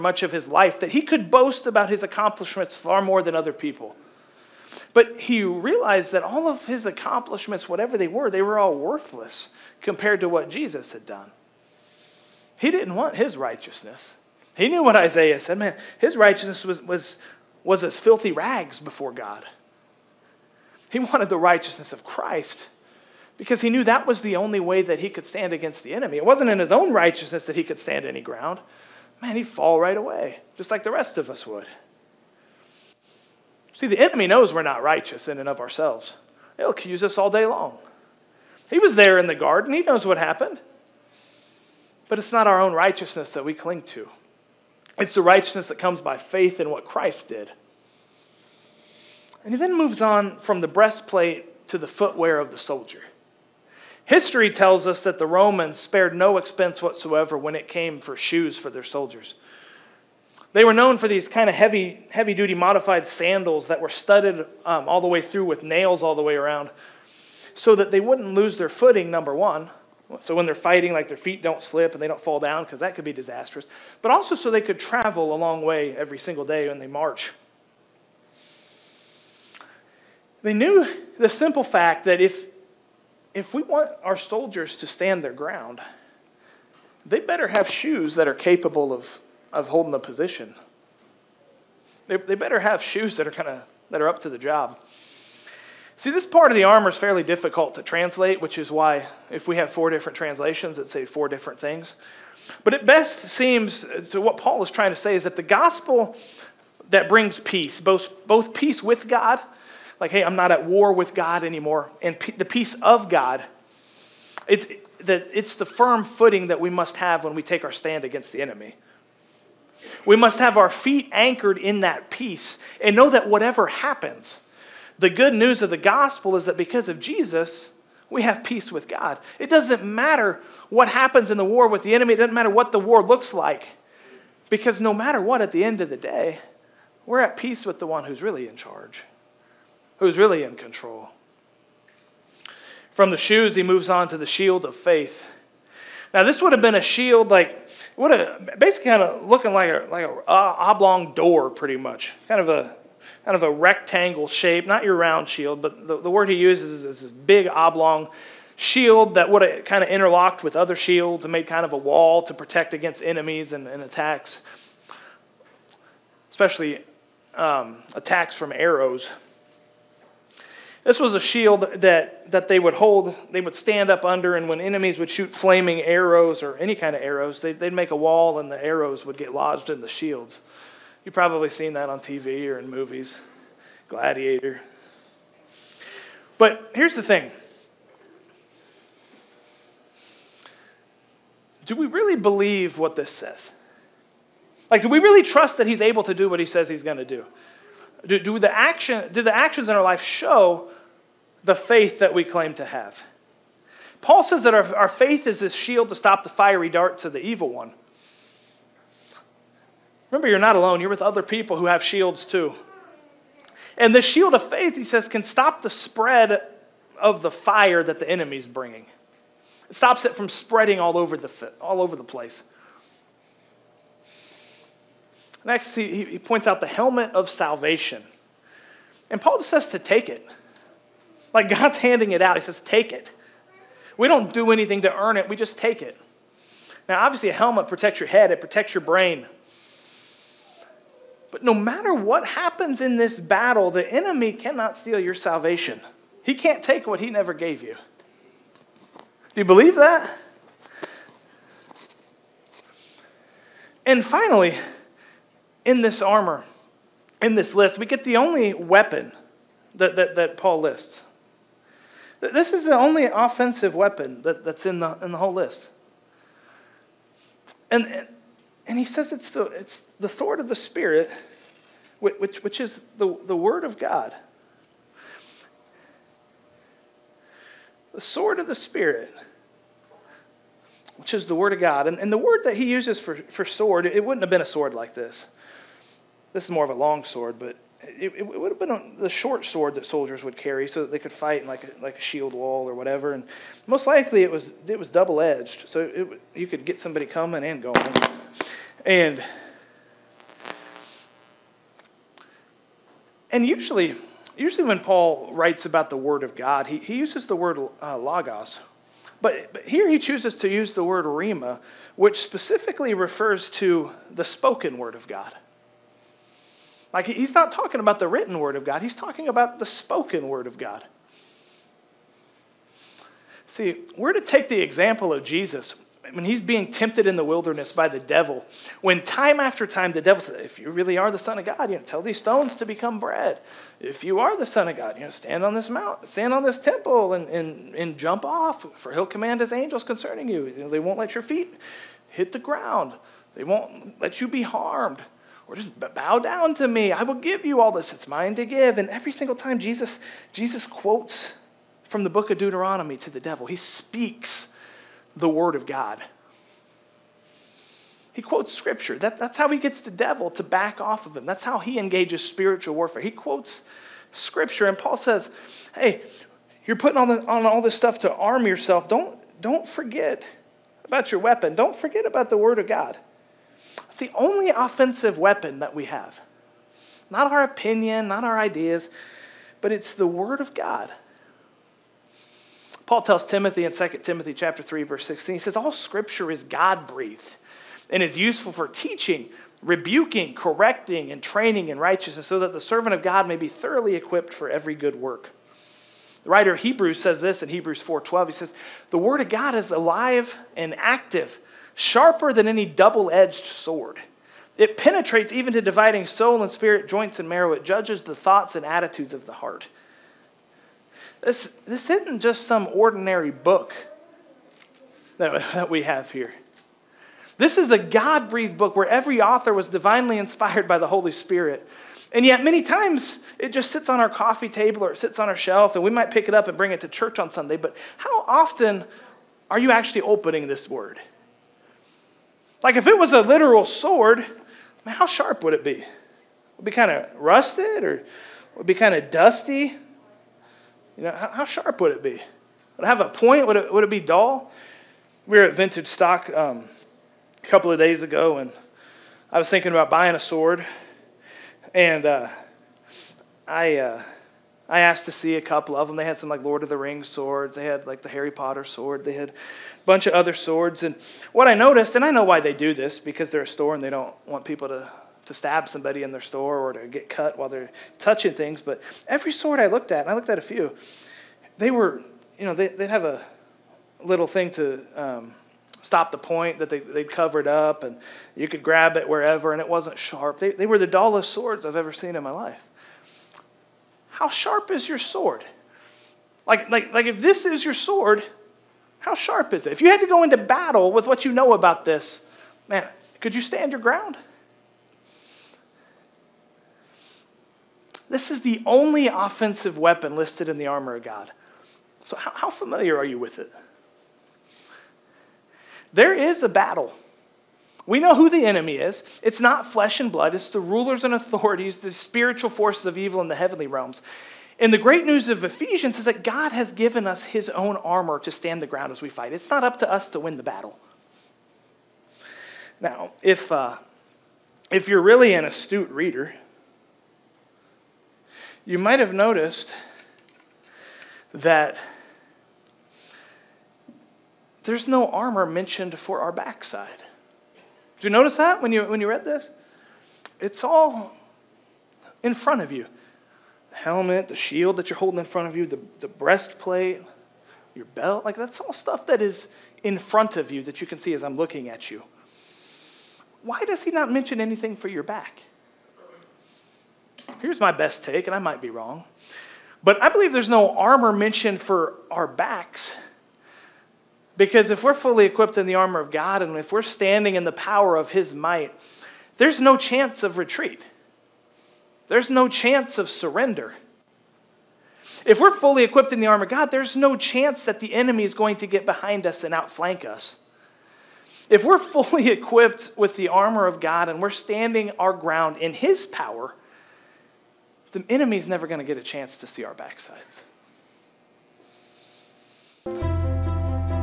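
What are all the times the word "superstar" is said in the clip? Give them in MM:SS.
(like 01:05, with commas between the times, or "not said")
not said.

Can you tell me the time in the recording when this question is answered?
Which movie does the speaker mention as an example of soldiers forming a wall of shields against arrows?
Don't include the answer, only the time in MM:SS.
03:03.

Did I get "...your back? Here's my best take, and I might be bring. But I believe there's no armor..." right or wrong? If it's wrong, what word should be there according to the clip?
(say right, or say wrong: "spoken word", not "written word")
wrong: "wrong", not "bring".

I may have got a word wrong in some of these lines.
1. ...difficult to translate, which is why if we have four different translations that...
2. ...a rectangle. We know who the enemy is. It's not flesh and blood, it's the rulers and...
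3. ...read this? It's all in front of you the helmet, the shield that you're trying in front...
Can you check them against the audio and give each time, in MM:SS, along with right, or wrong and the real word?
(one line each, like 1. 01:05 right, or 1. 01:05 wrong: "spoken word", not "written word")
1. 01:37 right
2. 08:26 wrong: "battle", not "rectangle"
3. 08:59 wrong: "holding", not "trying".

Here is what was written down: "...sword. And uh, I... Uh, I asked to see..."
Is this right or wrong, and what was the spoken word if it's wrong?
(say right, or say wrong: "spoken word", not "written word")
right.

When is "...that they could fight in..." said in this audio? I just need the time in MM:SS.
04:50.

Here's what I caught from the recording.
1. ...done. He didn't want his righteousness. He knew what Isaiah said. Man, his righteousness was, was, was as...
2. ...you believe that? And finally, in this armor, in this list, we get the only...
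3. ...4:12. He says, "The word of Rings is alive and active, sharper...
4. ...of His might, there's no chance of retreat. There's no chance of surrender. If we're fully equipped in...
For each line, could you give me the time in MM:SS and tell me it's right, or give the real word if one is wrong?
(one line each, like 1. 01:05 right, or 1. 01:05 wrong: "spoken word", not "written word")
1. 00:11 right
2. 04:09 right
3. 06:37 wrong: "God", not "Rings"
4. 09:27 right.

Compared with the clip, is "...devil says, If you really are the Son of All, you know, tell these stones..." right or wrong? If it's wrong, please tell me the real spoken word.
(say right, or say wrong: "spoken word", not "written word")
wrong: "God", not "All".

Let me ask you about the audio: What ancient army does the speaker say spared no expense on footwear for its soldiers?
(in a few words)
The Romans.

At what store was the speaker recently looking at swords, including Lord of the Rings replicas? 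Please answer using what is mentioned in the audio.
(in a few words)
Vintage Stock.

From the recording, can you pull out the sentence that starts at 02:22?
From the shoes, he moves on to the shield of faith.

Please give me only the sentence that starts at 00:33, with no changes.
See, the enemy knows we're not righteous in and of ourselves.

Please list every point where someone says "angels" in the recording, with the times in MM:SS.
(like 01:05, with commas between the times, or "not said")
05:39.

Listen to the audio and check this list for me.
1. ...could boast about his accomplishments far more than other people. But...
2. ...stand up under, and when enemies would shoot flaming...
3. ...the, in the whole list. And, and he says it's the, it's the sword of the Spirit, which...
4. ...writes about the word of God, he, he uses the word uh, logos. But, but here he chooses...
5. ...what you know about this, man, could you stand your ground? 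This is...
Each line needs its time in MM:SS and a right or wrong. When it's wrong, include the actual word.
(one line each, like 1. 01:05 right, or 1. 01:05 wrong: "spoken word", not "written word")
1. 00:01 right
2. 02:53 right
3. 04:24 right
4. 05:05 right
5. 08:11 right.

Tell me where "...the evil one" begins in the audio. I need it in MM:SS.
03:27.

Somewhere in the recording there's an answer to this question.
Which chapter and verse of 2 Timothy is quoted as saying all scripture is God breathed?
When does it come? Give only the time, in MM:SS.
06:24.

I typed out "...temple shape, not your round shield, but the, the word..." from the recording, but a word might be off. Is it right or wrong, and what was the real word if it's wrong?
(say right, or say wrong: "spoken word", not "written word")
wrong: "rectangle", not "temple".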